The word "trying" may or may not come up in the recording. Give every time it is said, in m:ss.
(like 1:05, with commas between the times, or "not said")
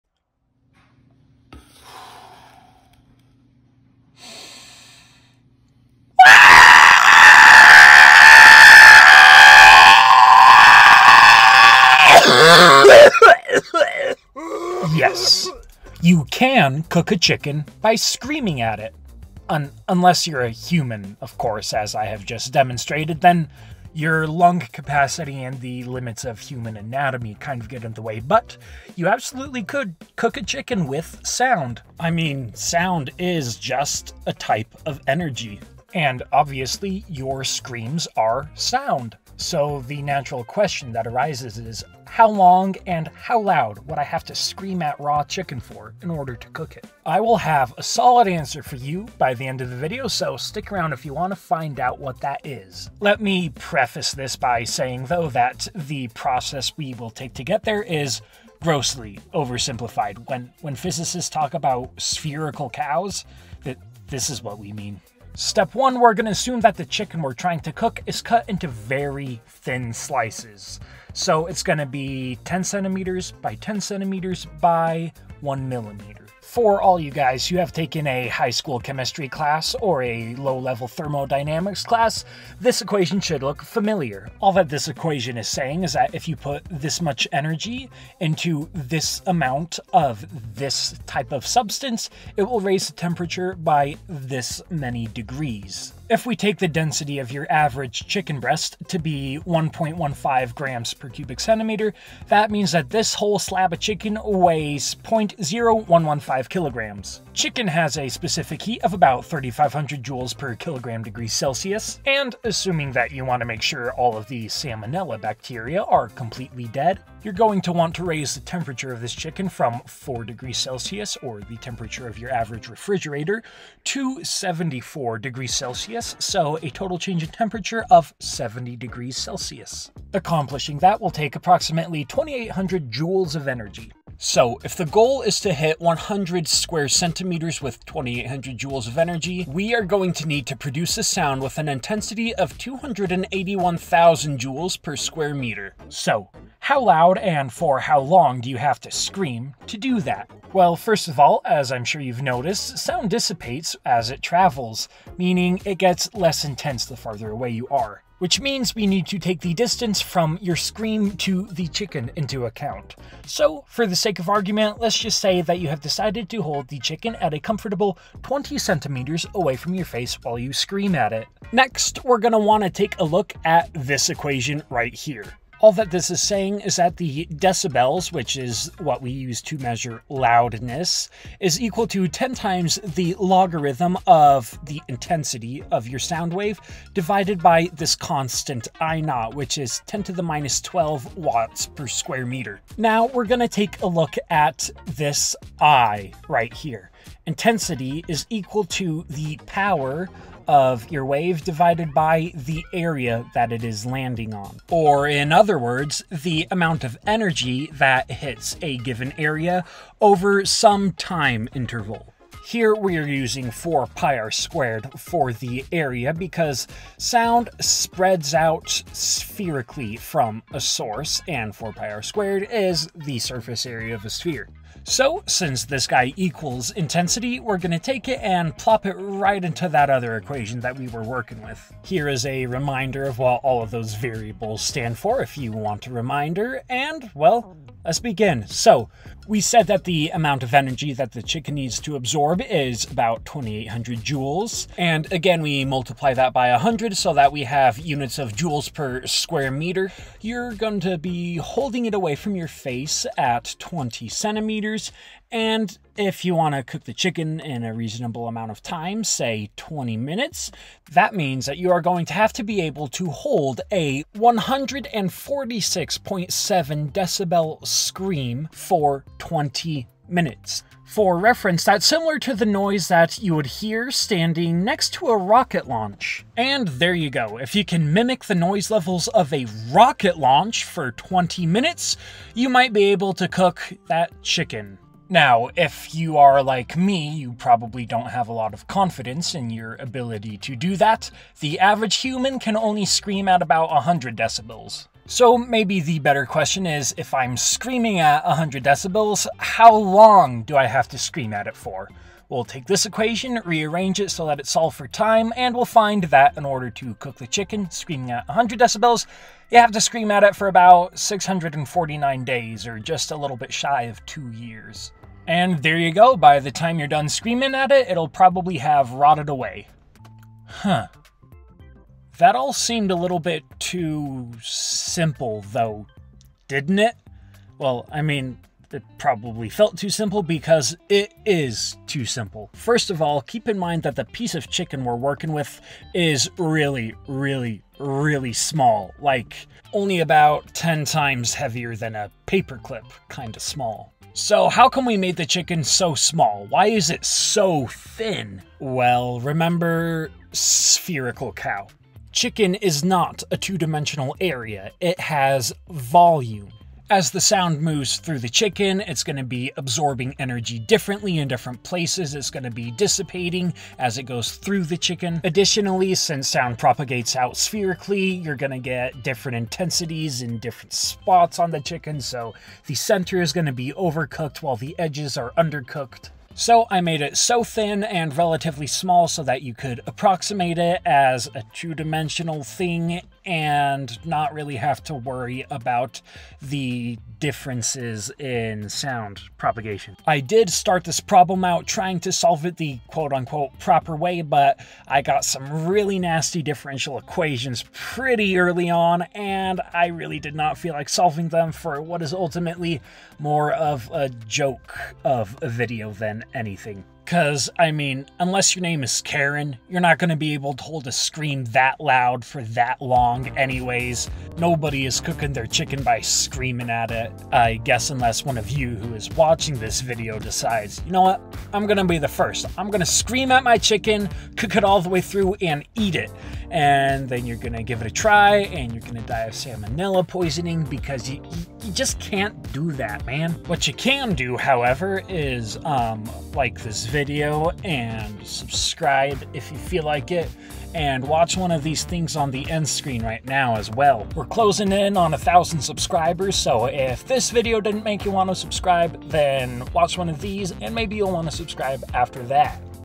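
1:07, 6:31.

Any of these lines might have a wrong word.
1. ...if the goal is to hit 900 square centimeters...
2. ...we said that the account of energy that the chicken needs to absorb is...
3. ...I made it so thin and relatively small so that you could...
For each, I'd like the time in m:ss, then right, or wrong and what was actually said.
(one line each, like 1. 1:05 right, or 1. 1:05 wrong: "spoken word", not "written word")
1. 2:14 wrong: "100", not "900"
2. 3:59 wrong: "amount", not "account"
3. 6:16 right.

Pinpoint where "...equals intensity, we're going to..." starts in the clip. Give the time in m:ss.
3:46.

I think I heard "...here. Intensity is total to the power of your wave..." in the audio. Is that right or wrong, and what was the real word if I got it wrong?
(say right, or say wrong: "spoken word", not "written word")
wrong: "equal", not "total".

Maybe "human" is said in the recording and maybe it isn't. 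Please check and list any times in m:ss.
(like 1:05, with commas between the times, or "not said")
0:20, 0:26, 4:51.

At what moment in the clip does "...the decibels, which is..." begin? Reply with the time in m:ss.
2:56.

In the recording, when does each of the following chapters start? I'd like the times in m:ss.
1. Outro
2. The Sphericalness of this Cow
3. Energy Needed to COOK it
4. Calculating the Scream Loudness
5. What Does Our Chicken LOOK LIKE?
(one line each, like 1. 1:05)
1. 7:15
2. 5:25
3. 1:22
4. 2:15
5. 1:07.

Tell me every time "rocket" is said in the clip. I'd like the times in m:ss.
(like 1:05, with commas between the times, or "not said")
4:35, 4:39.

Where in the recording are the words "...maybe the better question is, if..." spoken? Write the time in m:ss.
4:55.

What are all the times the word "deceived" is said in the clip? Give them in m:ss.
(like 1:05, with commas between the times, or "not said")
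not said.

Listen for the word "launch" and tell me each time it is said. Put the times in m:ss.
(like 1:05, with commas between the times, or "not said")
4:35, 4:40.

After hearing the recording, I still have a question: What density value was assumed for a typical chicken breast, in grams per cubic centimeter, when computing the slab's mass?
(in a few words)
1.15.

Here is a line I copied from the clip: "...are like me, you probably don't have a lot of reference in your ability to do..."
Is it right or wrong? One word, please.
wrong.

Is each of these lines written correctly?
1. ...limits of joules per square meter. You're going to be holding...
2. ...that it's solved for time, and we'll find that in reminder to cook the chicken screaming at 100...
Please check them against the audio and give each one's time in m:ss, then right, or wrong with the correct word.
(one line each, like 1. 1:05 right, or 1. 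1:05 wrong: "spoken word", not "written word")
1. 4:07 wrong: "units", not "limits"
2. 5:04 wrong: "order", not "reminder".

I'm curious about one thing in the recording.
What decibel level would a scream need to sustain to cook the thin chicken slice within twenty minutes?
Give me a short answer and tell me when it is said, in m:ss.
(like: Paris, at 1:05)
146.7 decibels, at 4:24.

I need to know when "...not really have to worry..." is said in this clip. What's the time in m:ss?
6:24.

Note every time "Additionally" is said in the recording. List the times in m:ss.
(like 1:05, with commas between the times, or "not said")
6:05.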